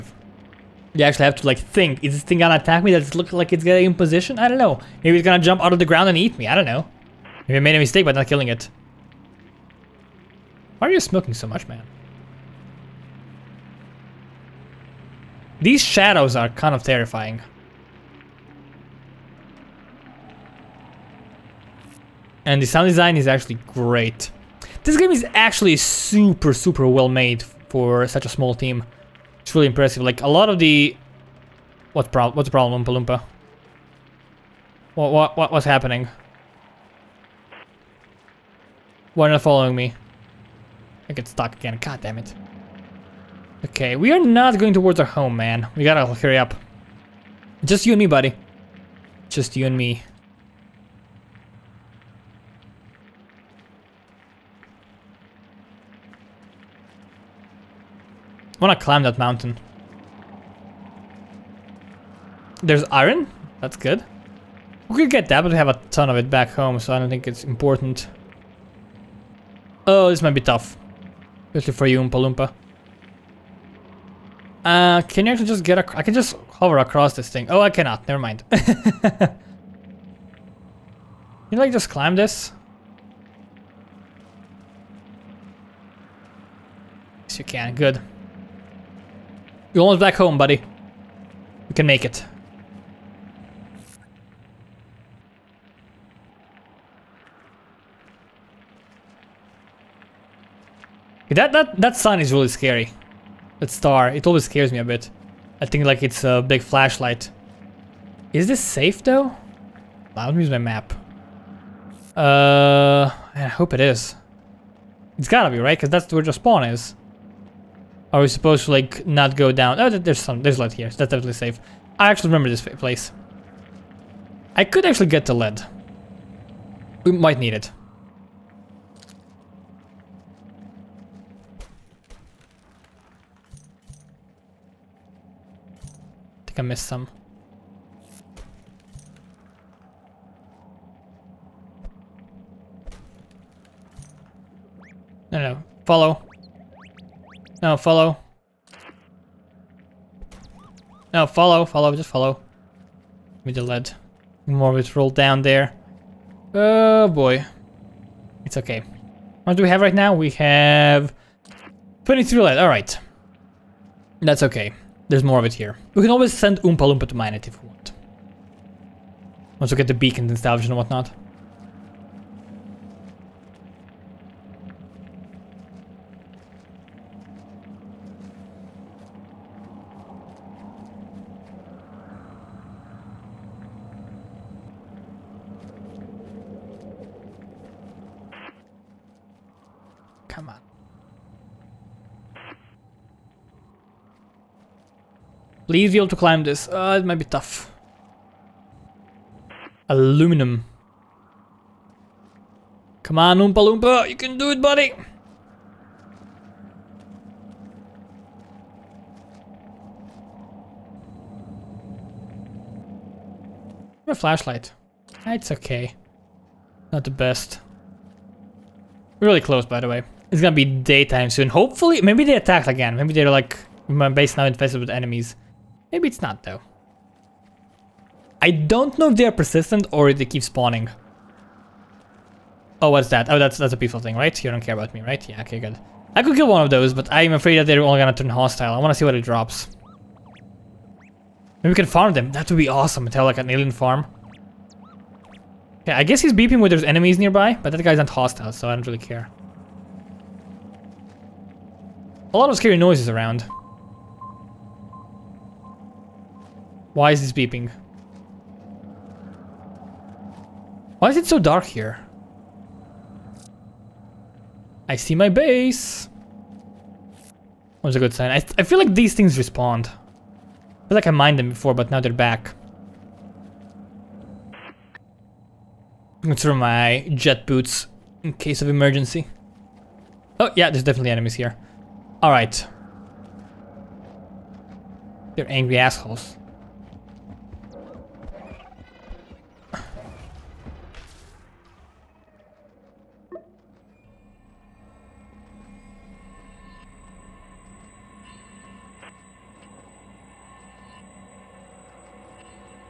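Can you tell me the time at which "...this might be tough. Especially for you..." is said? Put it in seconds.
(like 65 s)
70 s.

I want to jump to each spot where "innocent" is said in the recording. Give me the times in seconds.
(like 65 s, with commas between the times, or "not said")
not said.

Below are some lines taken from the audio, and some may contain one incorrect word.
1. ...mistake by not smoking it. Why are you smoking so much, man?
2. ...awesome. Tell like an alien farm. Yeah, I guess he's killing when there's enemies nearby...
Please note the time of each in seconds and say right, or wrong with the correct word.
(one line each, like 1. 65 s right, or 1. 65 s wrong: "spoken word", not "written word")
1. 7 s wrong: "killing", not "smoking"
2. 242 s wrong: "beeping", not "killing".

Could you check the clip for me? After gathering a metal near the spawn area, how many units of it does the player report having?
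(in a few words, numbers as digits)
23.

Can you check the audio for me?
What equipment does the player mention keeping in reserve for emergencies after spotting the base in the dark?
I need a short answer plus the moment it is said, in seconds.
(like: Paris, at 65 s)
Jet boots, at 277 s.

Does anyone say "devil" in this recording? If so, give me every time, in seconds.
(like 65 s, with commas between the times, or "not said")
not said.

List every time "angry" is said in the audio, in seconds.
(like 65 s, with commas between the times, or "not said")
285 s.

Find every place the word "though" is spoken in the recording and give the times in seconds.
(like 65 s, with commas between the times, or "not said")
109 s, 226 s.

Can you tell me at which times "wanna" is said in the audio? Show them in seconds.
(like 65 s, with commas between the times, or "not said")
58 s, 238 s.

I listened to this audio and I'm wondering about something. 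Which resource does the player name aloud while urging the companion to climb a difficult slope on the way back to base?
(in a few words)
Aluminum.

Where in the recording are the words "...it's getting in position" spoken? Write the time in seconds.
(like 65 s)
3 s.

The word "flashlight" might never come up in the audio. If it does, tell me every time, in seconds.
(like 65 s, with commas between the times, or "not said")
106 s, 214 s.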